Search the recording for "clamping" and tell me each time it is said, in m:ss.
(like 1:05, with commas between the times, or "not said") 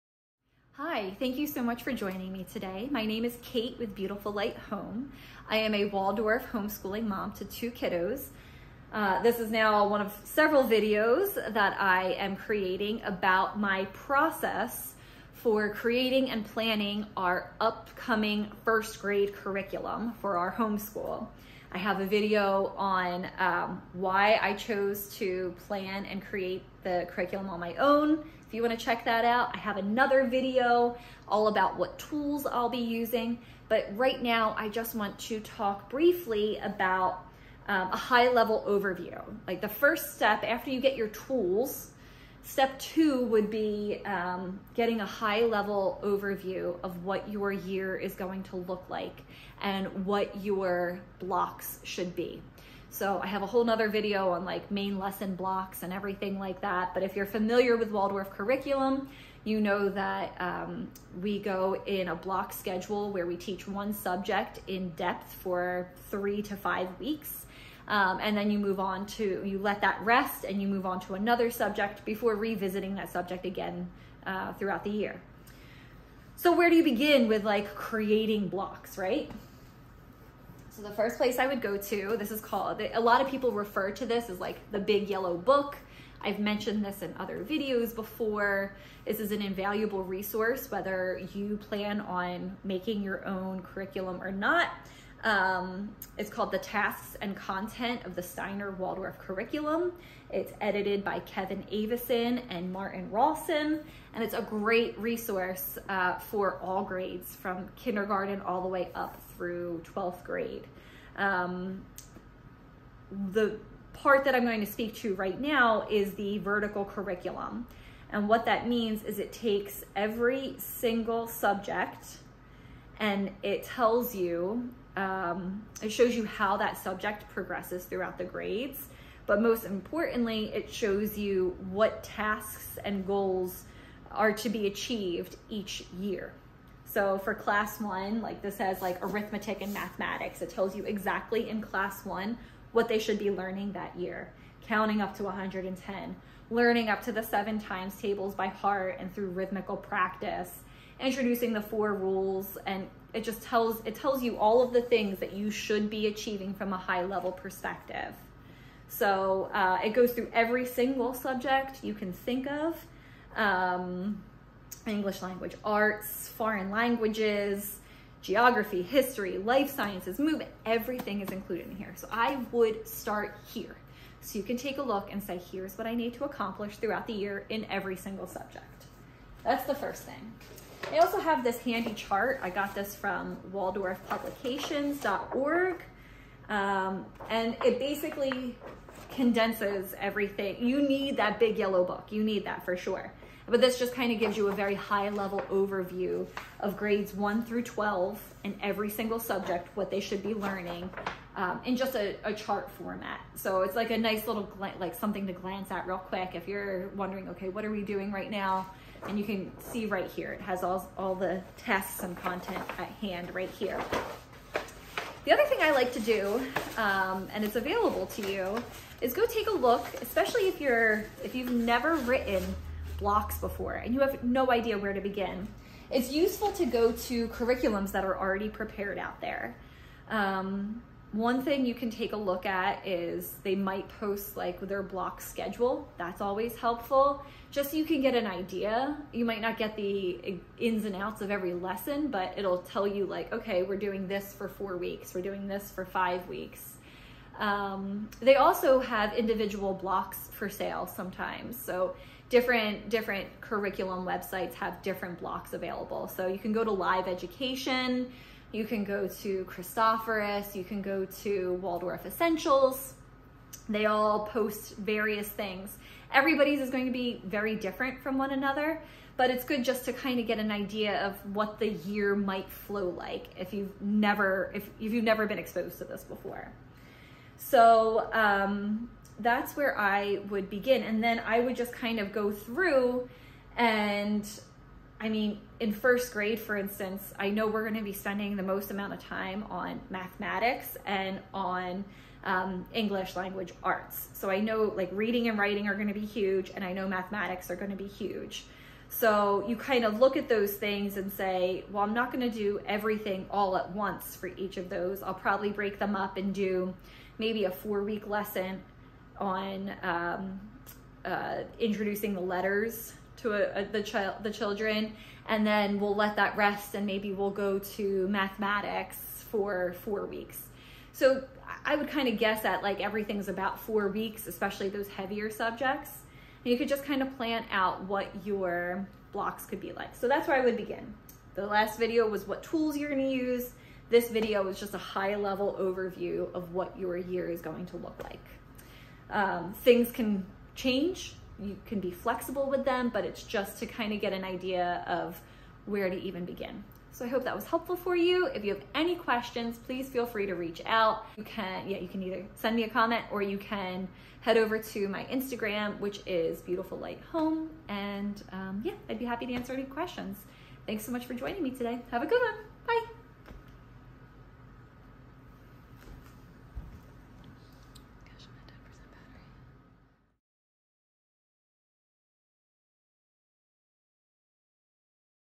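not said.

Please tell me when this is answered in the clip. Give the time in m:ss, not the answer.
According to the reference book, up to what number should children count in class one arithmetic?
2:25.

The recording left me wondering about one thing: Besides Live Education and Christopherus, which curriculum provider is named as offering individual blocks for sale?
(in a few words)
Waldorf Essentials.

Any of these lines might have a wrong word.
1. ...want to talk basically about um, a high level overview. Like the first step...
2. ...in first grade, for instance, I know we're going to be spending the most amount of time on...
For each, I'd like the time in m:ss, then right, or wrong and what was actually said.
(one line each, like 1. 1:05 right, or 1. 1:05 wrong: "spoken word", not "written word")
1. 0:34 wrong: "briefly", not "basically"
2. 4:45 right.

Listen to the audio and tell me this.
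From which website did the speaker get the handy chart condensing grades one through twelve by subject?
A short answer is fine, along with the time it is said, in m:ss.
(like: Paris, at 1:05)
waldorfpublications.org, at 3:03.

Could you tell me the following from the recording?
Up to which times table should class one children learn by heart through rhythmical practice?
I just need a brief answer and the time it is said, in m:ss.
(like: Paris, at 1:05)
seven times tables, at 2:27.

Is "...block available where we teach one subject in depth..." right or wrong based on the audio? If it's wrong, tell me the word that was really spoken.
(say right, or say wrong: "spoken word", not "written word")
wrong: "schedule", not "available".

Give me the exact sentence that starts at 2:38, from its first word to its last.
So uh, it goes through every single subject you can think of.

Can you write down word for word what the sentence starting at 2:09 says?
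But most importantly, it shows you what tasks and goals are to be achieved each year.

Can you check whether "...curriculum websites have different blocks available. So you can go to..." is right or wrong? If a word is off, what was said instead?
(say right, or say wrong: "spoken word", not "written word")
right.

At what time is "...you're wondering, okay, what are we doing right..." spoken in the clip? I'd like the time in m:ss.
3:26.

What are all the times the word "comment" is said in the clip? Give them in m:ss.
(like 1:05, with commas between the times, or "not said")
5:52.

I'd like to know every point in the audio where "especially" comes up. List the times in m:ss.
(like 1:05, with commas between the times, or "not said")
3:40, 5:24.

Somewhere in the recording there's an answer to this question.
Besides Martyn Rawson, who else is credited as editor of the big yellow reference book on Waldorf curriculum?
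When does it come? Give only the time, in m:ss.
1:41.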